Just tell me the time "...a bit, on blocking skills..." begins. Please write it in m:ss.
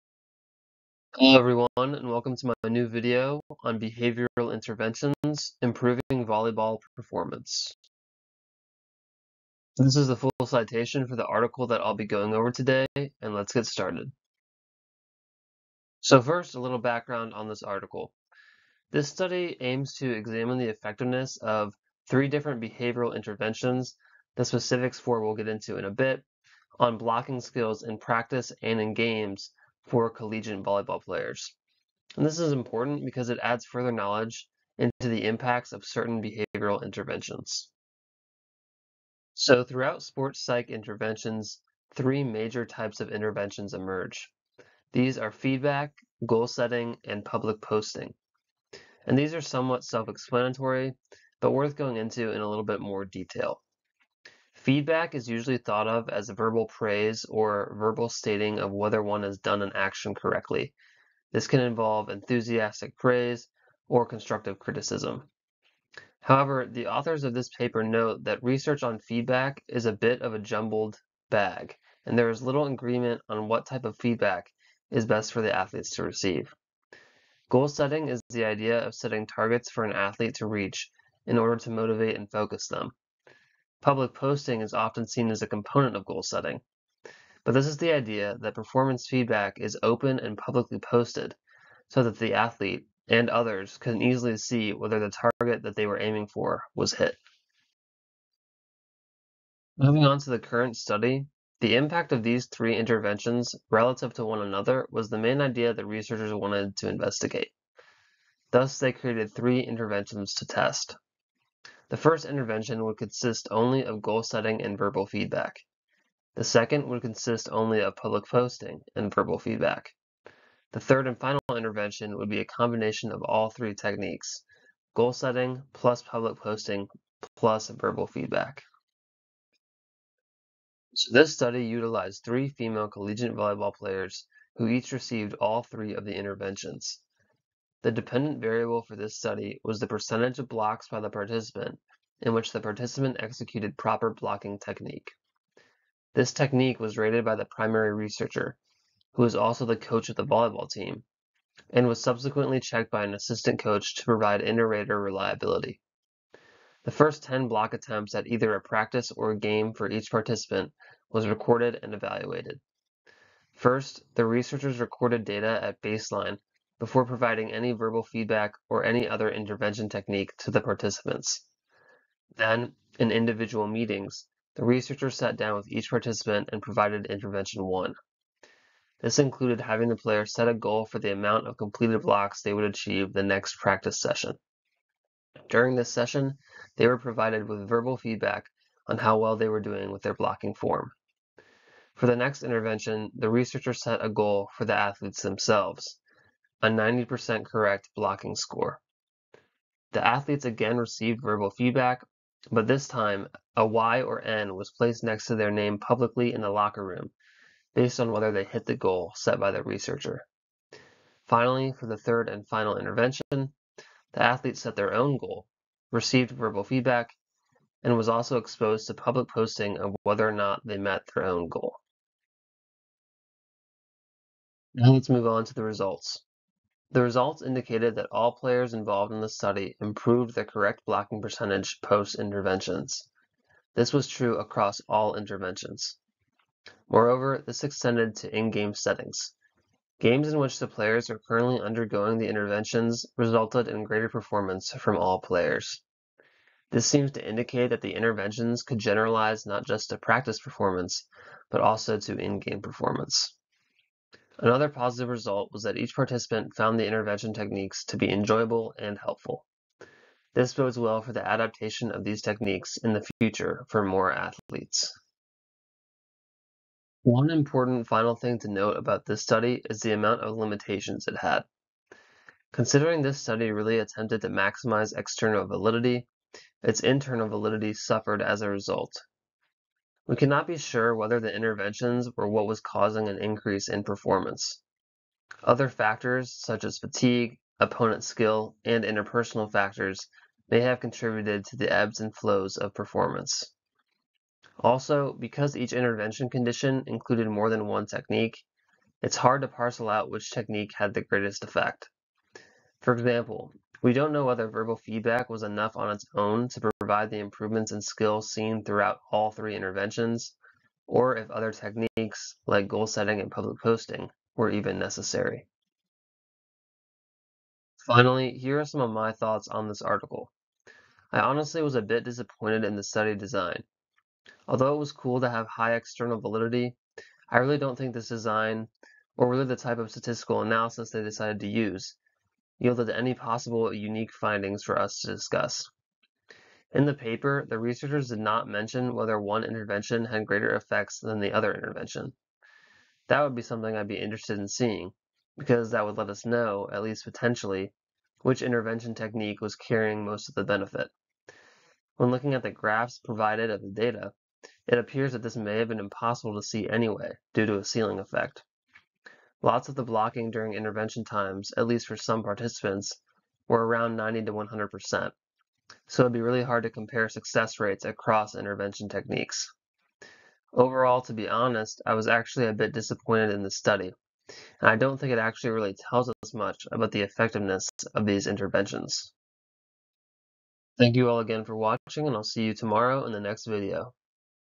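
0:25.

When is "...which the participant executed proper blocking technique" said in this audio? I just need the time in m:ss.
2:22.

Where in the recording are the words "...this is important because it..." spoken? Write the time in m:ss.
0:32.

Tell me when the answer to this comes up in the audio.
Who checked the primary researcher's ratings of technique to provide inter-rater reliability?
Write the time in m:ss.
2:33.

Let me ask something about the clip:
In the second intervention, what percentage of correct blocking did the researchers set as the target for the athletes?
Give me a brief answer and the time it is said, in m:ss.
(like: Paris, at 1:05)
90%, at 3:16.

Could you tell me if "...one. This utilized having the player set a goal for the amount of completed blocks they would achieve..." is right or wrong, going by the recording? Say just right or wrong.
wrong.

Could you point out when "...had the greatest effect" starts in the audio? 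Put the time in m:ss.
5:00.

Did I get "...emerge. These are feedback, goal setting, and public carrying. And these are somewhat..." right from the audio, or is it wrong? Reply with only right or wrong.
wrong.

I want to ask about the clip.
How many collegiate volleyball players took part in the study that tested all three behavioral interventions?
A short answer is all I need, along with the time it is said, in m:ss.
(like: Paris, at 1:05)
3, at 2:12.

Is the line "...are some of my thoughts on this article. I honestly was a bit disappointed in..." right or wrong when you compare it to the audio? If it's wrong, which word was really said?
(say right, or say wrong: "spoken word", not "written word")
right.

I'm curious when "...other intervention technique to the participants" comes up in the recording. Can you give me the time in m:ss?
2:49.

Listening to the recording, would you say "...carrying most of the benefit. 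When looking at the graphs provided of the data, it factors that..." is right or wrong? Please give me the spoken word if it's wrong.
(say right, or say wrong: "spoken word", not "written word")
wrong: "appears", not "factors".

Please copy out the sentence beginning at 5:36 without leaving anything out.
In the paper, the researchers did not mention whether one intervention had greater effects than the other intervention.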